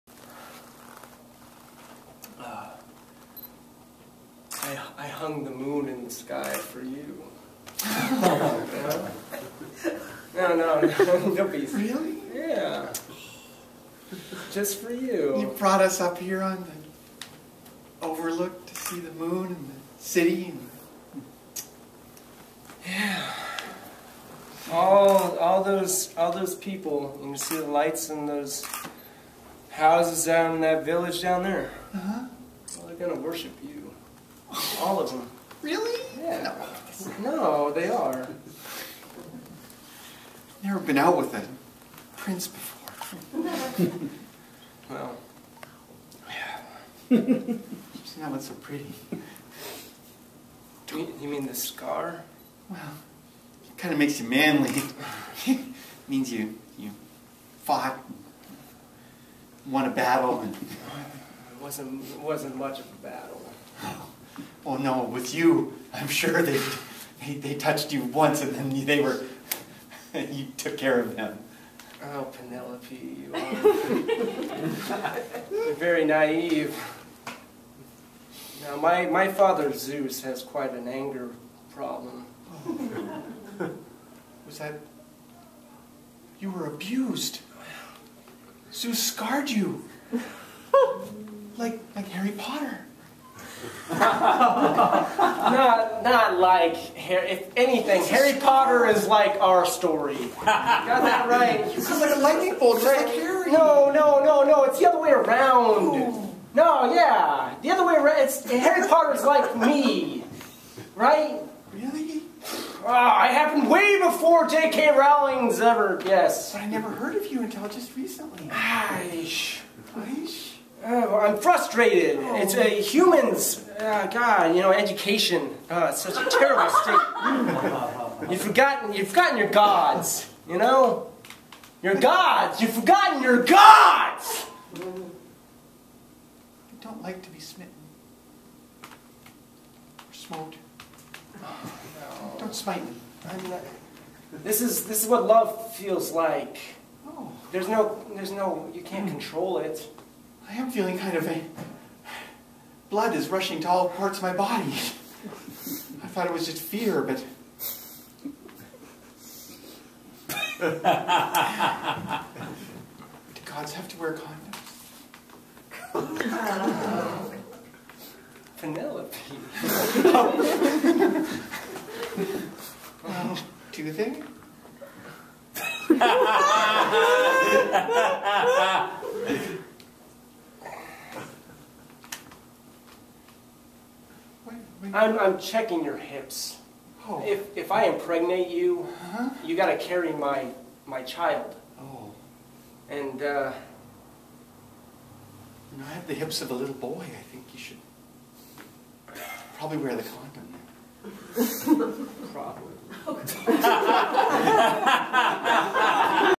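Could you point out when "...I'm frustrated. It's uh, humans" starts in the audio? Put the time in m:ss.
2:01.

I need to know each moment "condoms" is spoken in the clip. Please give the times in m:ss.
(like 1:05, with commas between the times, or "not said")
2:45, 3:20.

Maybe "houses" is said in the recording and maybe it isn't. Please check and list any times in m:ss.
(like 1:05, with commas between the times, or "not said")
0:29.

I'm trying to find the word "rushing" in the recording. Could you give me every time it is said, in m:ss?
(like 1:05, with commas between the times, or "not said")
2:33.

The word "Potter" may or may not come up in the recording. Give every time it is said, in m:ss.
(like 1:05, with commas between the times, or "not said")
1:38, 1:48.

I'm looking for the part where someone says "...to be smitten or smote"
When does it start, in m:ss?
2:17.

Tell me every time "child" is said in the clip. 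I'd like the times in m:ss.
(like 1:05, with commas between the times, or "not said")
3:11.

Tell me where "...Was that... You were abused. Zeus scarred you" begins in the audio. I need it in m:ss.
1:24.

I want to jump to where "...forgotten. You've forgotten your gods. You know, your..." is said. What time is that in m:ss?
2:08.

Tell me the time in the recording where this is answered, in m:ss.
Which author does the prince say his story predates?
1:54.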